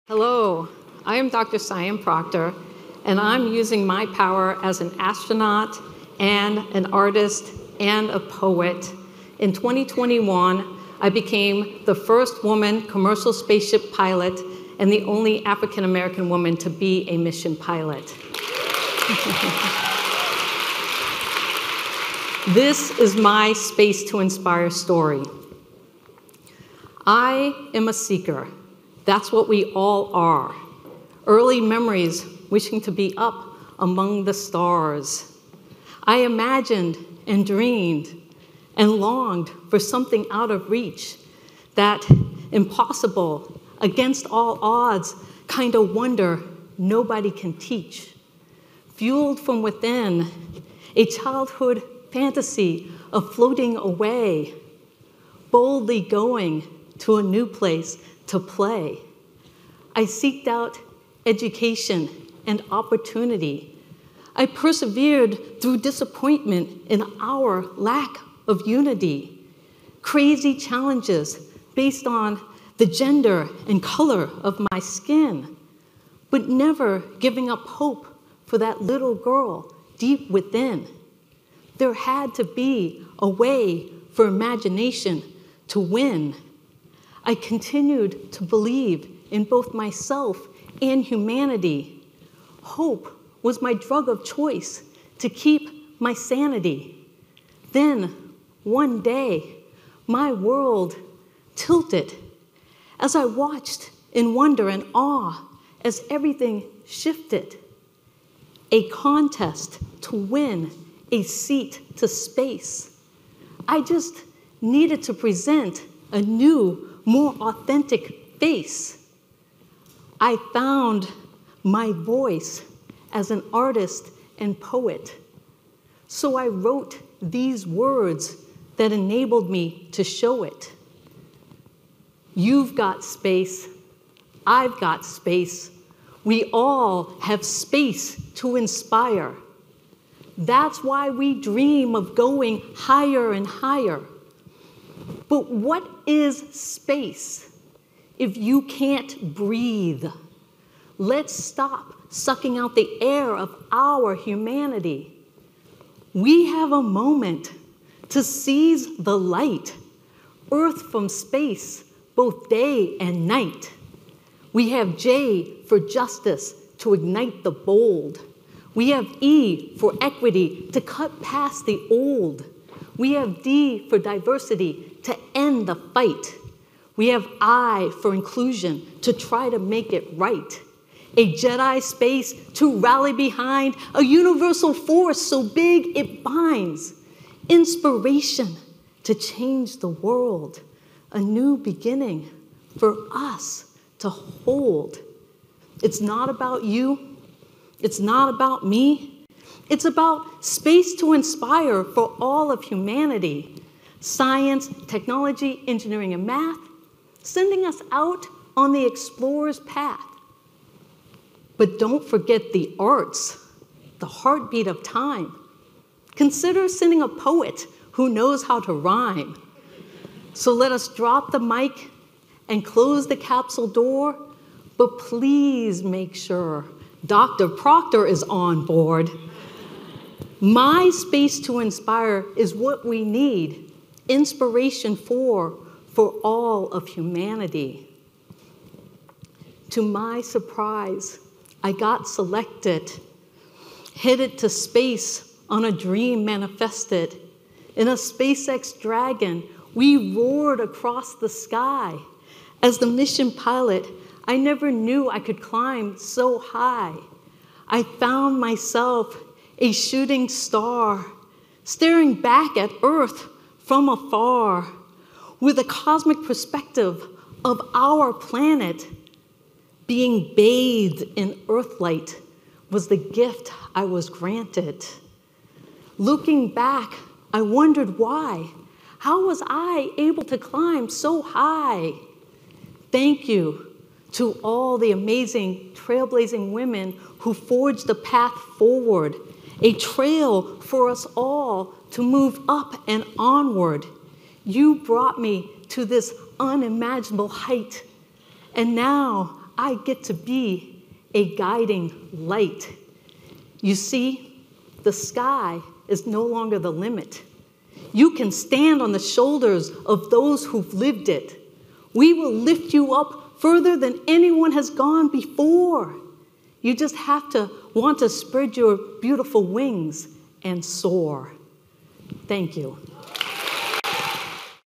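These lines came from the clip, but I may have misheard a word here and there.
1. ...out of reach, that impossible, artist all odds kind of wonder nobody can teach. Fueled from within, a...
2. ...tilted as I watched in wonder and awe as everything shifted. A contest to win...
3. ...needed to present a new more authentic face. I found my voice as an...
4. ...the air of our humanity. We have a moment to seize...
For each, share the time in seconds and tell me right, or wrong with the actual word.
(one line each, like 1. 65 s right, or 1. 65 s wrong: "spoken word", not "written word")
1. 40 s wrong: "against", not "artist"
2. 101 s right
3. 114 s right
4. 152 s right.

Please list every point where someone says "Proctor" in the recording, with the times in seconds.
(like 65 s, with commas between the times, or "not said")
1 s, 227 s.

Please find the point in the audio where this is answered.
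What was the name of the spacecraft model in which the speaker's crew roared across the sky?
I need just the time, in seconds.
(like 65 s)
247 s.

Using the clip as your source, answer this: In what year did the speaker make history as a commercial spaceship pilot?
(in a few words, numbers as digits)
2021.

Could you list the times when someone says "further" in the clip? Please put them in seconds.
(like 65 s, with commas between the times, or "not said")
313 s.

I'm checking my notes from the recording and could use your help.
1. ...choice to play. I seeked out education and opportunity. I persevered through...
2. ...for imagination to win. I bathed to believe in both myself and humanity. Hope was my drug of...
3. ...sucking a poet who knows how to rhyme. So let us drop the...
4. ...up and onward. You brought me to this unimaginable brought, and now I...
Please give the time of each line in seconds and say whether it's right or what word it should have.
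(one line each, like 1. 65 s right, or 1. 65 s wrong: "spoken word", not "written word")
1. 57 s wrong: "place", not "choice"
2. 84 s wrong: "continued", not "bathed"
3. 216 s wrong: "sending", not "sucking"
4. 292 s wrong: "height", not "brought".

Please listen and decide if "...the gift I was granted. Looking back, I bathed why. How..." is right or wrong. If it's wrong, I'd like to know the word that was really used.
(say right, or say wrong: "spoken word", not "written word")
wrong: "wondered", not "bathed".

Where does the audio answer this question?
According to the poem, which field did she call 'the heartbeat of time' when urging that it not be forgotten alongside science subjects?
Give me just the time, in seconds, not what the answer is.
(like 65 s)
212 s.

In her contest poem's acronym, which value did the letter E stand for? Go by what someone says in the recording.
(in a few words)
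Equity.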